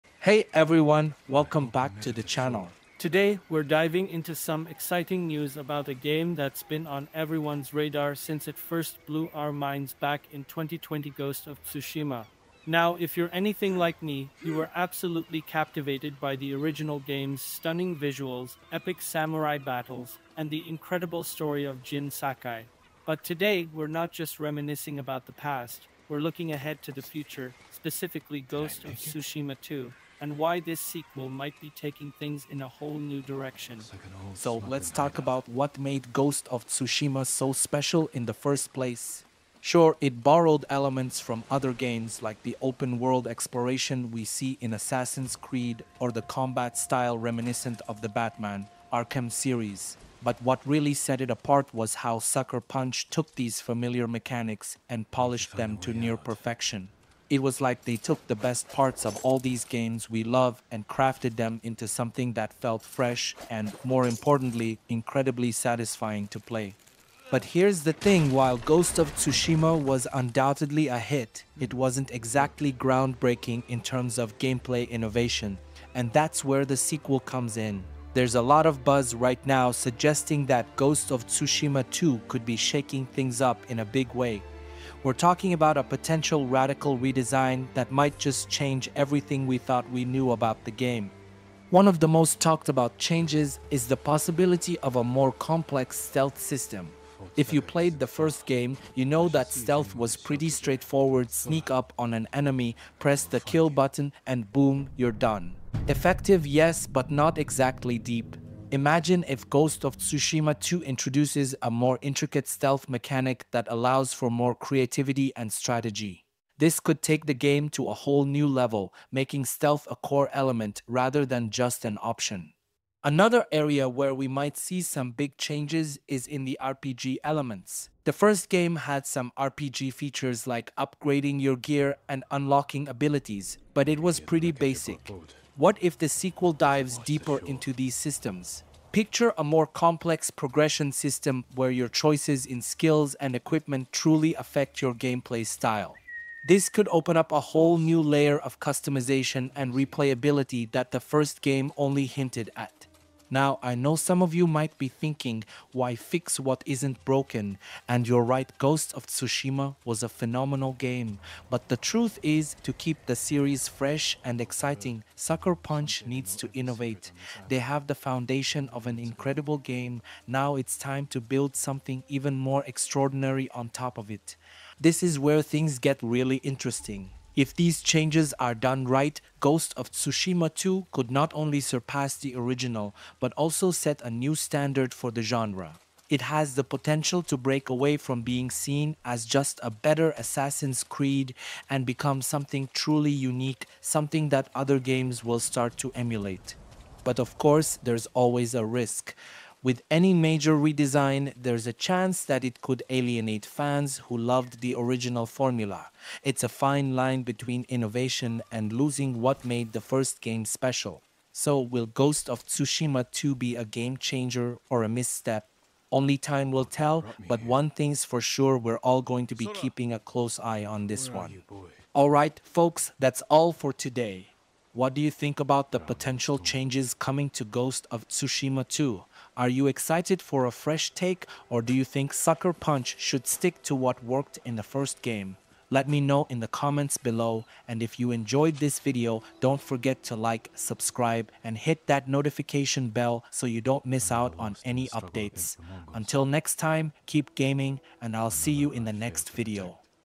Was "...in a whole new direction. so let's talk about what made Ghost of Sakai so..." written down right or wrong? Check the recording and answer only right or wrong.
wrong.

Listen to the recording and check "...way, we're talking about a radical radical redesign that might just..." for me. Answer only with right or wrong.
wrong.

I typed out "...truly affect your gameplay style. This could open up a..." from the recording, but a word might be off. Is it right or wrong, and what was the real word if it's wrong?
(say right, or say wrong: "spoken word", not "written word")
right.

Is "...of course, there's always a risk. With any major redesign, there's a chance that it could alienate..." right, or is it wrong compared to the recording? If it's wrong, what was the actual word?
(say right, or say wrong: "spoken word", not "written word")
right.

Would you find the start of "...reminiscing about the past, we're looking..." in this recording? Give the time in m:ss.
0:24.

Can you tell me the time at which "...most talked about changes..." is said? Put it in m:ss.
1:32.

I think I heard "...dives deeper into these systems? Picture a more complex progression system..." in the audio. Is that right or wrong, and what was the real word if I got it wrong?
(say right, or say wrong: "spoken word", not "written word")
right.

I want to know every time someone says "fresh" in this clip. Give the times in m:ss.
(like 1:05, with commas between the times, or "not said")
1:02, 2:43, 3:50.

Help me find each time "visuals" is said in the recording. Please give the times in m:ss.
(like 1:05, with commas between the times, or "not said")
0:17.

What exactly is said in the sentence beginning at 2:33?
Now, I know some of you might be thinking, why fix what isn't broken?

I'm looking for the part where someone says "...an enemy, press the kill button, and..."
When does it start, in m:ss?
1:42.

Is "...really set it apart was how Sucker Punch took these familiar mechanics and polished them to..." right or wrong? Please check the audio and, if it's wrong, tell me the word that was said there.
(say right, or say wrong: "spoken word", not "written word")
right.